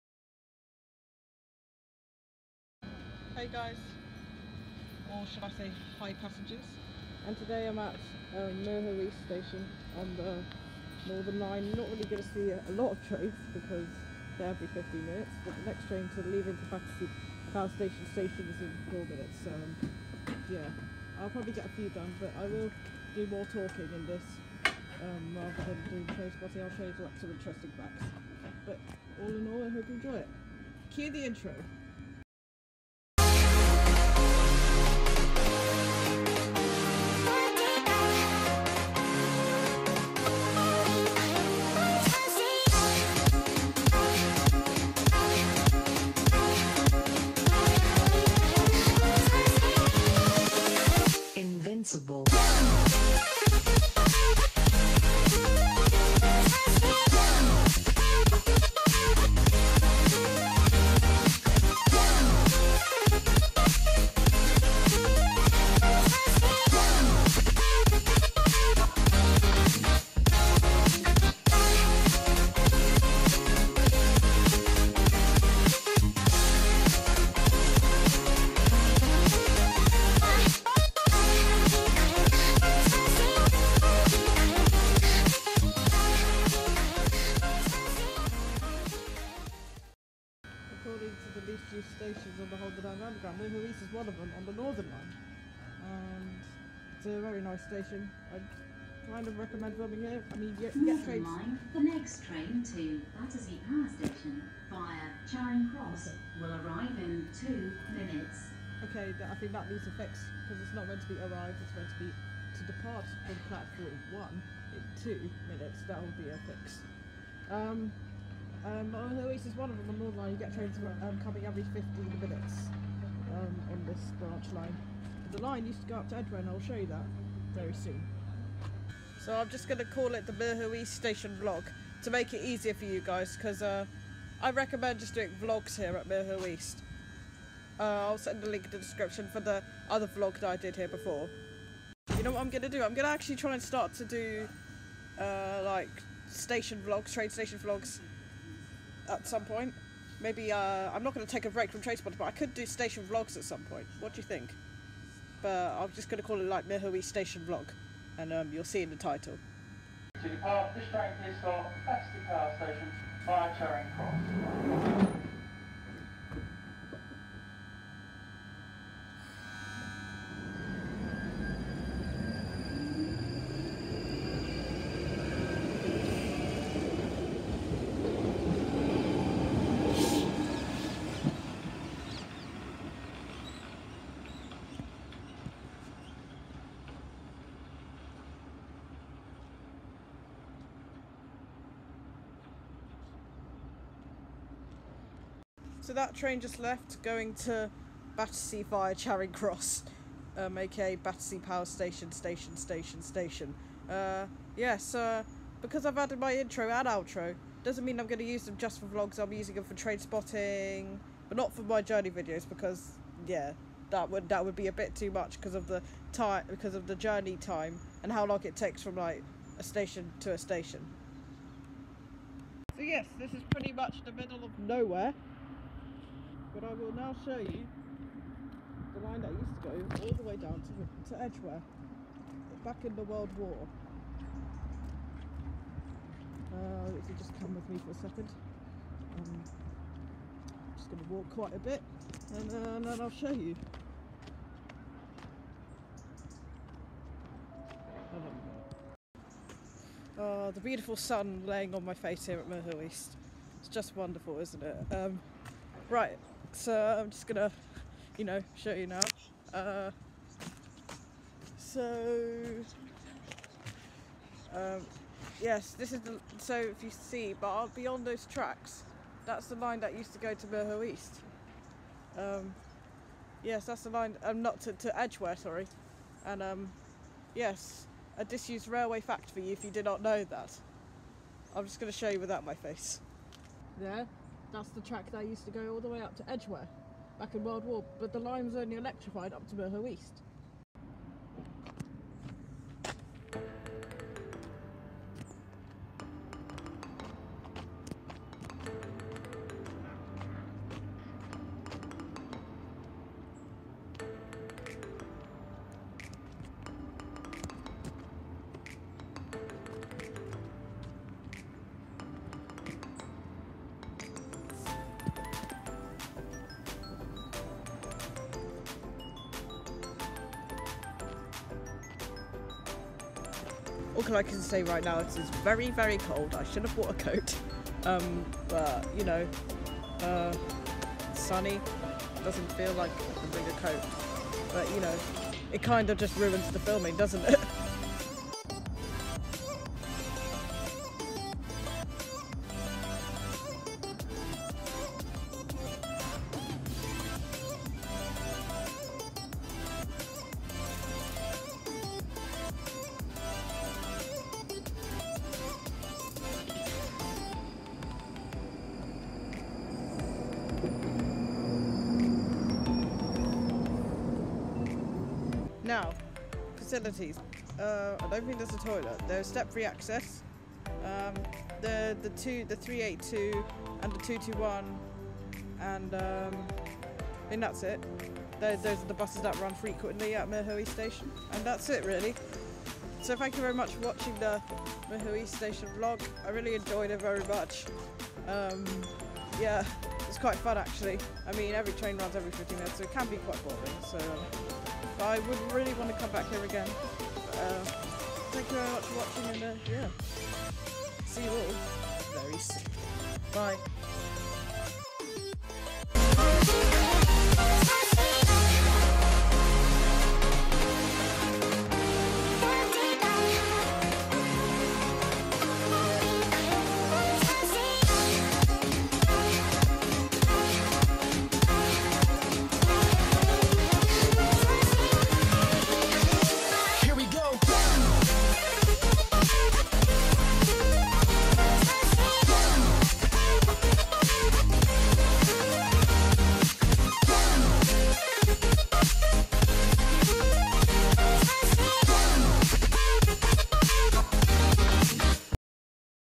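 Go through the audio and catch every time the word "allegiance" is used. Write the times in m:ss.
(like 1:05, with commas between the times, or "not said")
not said.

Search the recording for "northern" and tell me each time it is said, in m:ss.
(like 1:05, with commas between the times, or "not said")
0:11, 1:34, 2:00.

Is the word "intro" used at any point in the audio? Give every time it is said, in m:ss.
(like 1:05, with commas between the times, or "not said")
0:31, 3:26.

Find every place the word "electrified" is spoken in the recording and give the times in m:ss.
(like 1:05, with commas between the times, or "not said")
4:48.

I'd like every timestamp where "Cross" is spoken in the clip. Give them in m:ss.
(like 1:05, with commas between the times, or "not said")
1:45, 2:43, 3:19.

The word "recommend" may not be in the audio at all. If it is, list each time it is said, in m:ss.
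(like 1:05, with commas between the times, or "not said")
1:39, 2:14.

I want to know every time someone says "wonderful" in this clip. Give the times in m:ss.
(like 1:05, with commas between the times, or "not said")
4:13.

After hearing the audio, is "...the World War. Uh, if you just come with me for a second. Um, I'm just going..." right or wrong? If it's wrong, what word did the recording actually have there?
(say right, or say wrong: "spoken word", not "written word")
right.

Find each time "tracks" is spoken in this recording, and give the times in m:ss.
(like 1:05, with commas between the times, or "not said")
4:28, 4:44.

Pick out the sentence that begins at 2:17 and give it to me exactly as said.
Uh, I'll send a link in the description for the other vlog that I did here before.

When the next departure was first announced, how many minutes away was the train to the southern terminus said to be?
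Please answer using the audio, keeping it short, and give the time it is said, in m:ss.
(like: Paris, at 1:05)
4, at 0:18.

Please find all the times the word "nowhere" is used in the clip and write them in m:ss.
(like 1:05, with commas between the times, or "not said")
3:44.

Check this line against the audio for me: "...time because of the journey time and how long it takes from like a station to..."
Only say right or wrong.
right.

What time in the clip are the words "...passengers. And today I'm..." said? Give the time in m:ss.
0:06.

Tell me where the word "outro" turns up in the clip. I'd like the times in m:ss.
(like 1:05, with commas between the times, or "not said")
3:26.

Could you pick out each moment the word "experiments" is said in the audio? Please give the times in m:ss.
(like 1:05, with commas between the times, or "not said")
not said.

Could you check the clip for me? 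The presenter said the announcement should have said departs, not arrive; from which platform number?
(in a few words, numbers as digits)
1.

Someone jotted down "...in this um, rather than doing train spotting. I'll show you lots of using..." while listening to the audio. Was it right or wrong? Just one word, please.
wrong.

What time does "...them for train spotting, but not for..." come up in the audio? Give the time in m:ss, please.
3:29.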